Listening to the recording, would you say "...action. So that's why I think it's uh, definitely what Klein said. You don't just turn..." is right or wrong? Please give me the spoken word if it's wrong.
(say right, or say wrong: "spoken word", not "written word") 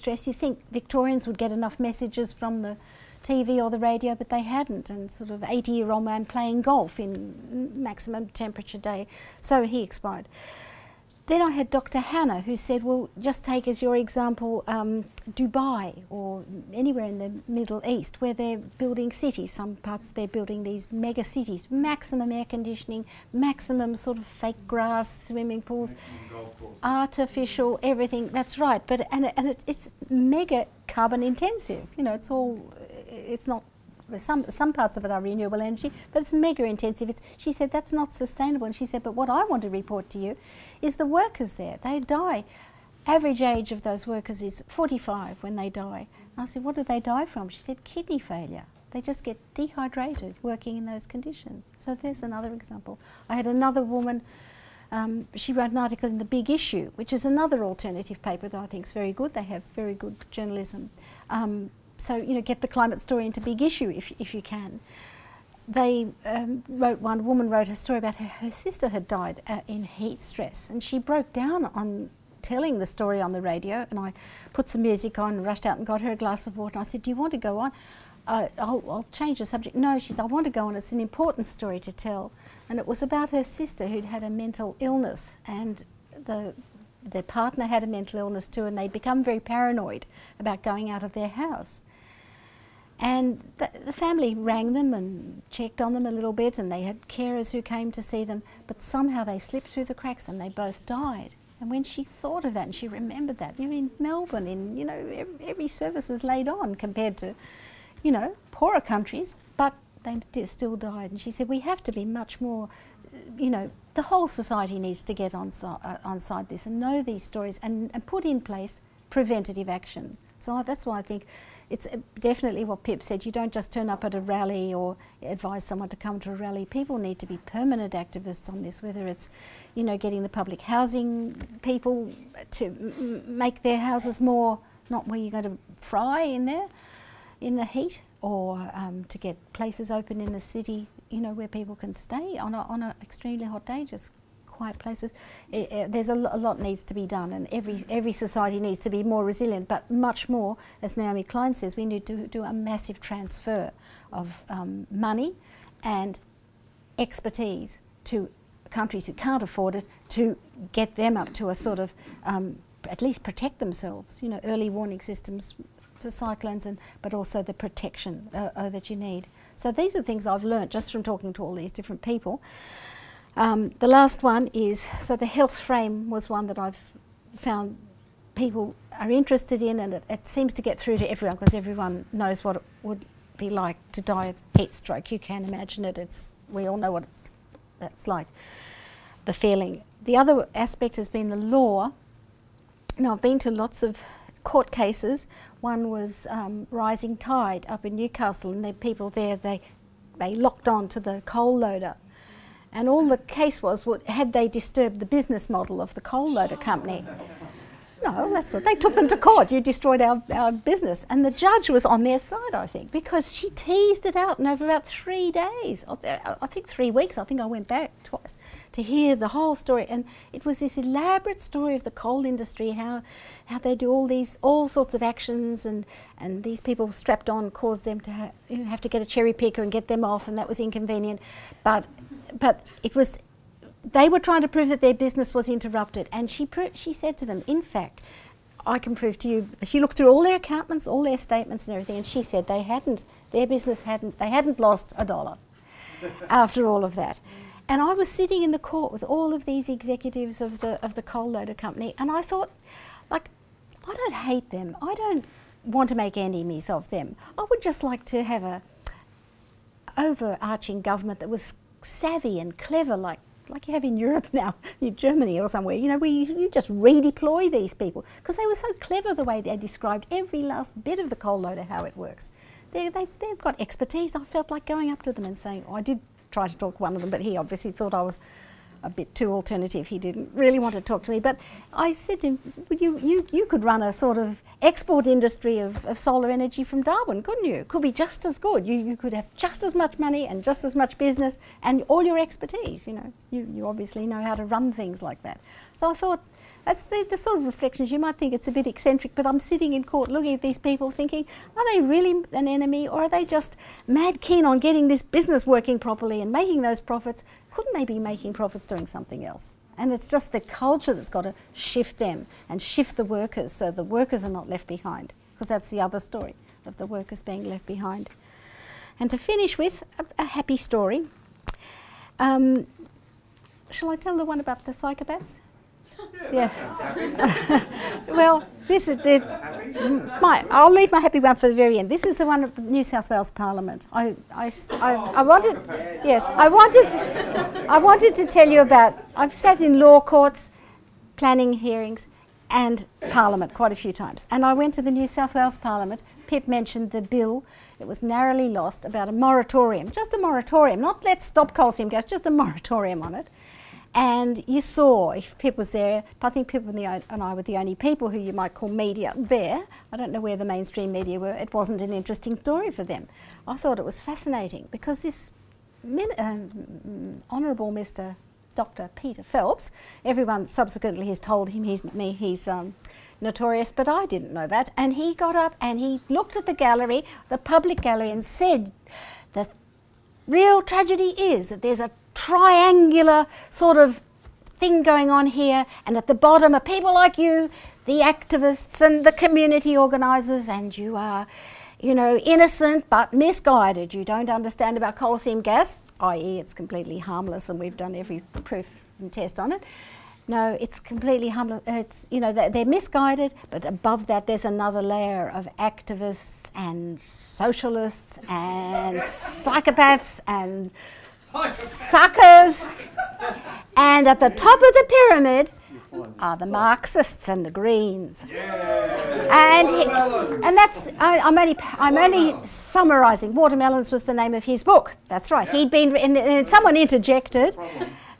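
wrong: "Pip", not "Klein".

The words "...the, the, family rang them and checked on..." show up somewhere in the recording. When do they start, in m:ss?
1:33.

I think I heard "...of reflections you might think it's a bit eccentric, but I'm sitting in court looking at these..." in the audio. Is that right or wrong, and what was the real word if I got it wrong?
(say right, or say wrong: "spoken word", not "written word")
right.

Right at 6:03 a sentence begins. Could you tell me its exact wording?
I thought it was fascinating because this um, honourable Mr.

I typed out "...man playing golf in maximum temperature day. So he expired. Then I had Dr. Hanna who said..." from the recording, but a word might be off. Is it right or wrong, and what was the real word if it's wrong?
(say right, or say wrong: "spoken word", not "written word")
right.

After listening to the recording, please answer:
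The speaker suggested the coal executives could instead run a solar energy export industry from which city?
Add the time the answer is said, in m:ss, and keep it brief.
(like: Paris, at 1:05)
Darwin, at 4:46.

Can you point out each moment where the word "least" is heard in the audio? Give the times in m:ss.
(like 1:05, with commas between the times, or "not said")
2:43.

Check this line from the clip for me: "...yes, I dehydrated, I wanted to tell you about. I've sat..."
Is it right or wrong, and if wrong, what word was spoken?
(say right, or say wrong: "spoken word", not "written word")
wrong: "wanted", not "dehydrated".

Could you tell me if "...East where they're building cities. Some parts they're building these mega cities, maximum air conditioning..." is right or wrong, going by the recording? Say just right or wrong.
right.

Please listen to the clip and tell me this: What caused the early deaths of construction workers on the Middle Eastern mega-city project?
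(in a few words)
Kidney failure.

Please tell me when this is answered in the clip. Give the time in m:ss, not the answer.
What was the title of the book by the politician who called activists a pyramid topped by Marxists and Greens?
7:03.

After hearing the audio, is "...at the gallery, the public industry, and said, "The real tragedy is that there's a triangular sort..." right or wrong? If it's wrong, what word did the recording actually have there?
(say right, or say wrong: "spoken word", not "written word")
wrong: "gallery", not "industry".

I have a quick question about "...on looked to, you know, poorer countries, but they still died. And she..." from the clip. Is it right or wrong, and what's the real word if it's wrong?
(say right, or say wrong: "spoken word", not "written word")
wrong: "compared", not "looked".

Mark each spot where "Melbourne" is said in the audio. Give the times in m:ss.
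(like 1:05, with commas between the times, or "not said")
1:43.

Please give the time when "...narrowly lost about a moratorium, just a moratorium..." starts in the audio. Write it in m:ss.
5:48.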